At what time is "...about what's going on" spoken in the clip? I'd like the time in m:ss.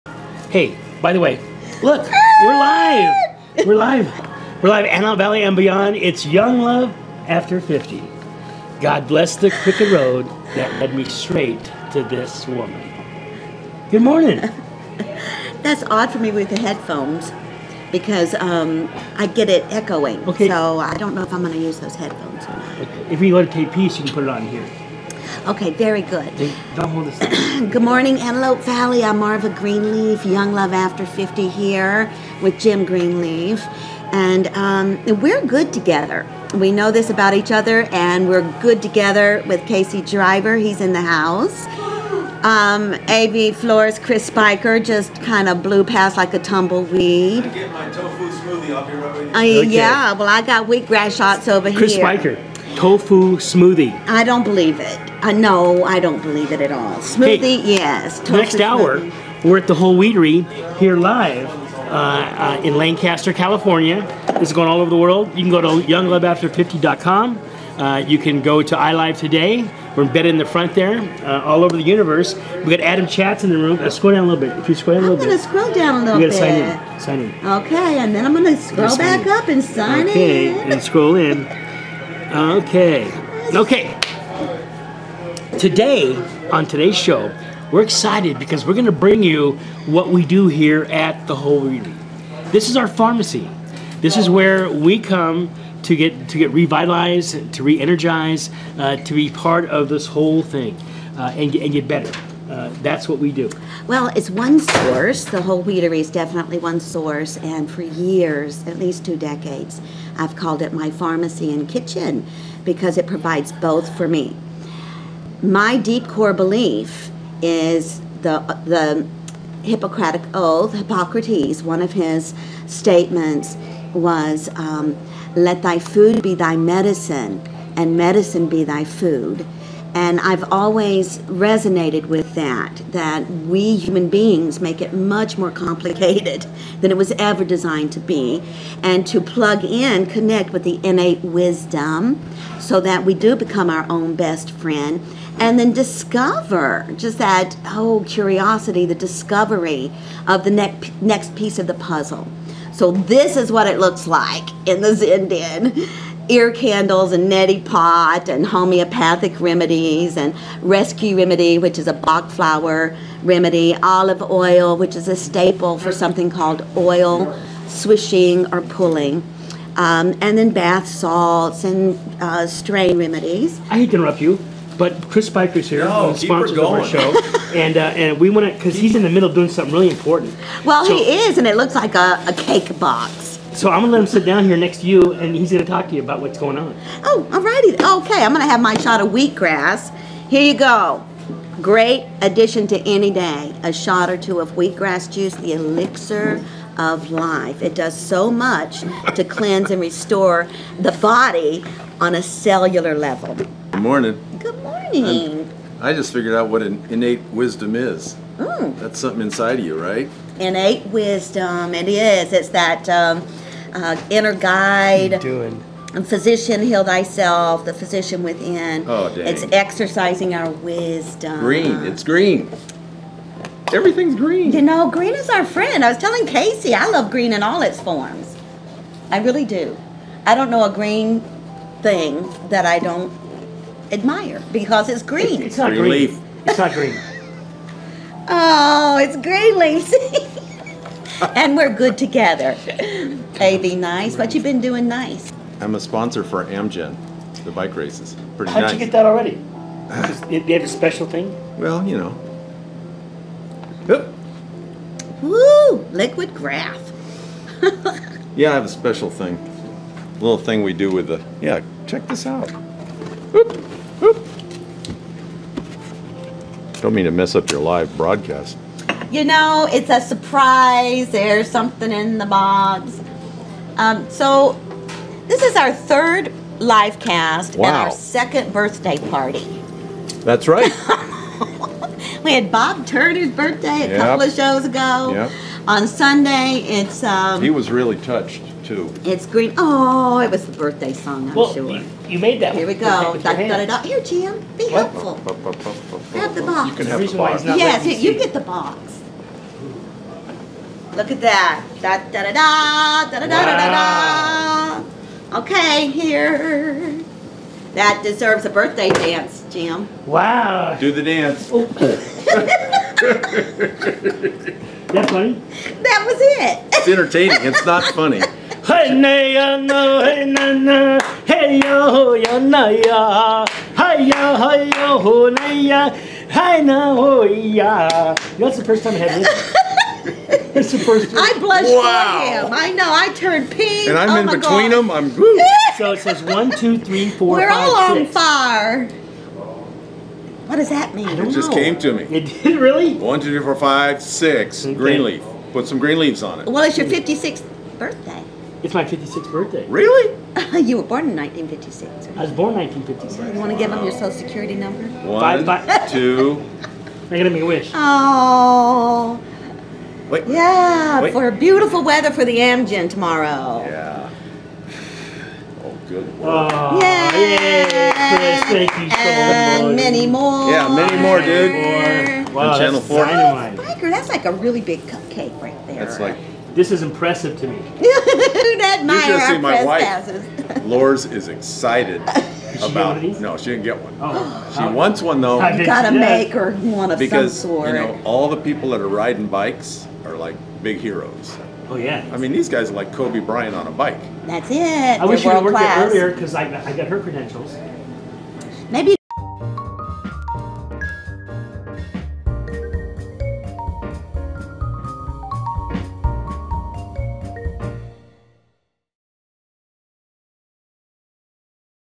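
3:06.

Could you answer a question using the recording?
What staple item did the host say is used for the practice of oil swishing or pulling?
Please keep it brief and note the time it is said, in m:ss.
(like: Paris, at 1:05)
olive oil, at 2:43.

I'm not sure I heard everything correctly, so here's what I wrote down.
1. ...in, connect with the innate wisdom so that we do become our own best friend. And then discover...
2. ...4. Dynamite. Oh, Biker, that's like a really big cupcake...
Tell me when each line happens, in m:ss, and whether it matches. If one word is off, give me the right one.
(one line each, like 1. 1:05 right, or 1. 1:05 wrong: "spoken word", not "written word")
1. 2:19 right
2. 6:12 right.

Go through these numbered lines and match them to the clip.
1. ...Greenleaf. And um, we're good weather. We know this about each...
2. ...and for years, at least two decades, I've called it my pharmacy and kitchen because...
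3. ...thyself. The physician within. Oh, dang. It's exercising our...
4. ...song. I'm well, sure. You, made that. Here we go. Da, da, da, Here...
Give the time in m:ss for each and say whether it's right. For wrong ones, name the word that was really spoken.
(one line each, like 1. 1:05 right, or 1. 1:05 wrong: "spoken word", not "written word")
1. 0:32 wrong: "together", not "weather"
2. 1:47 right
3. 3:36 right
4. 4:50 right.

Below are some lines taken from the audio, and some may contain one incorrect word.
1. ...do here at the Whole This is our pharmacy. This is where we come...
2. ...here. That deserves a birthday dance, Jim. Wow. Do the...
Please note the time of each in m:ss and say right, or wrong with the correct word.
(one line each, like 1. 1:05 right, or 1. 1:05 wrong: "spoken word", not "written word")
1. 1:30 right
2. 5:05 right.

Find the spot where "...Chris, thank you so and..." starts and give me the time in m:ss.
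6:06.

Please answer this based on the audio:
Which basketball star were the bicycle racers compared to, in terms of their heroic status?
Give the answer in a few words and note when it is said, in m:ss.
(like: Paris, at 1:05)
Kobe Bryant, at 6:32.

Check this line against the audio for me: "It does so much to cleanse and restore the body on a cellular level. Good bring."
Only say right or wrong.
wrong.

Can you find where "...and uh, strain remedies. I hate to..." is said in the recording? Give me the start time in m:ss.
2:51.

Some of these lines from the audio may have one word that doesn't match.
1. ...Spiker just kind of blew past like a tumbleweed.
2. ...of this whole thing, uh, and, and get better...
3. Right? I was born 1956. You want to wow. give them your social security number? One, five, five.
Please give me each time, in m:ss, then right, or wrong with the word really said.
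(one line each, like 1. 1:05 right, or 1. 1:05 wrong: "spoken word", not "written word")
1. 0:44 right
2. 1:39 right
3. 5:52 right.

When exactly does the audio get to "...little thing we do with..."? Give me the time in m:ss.
4:20.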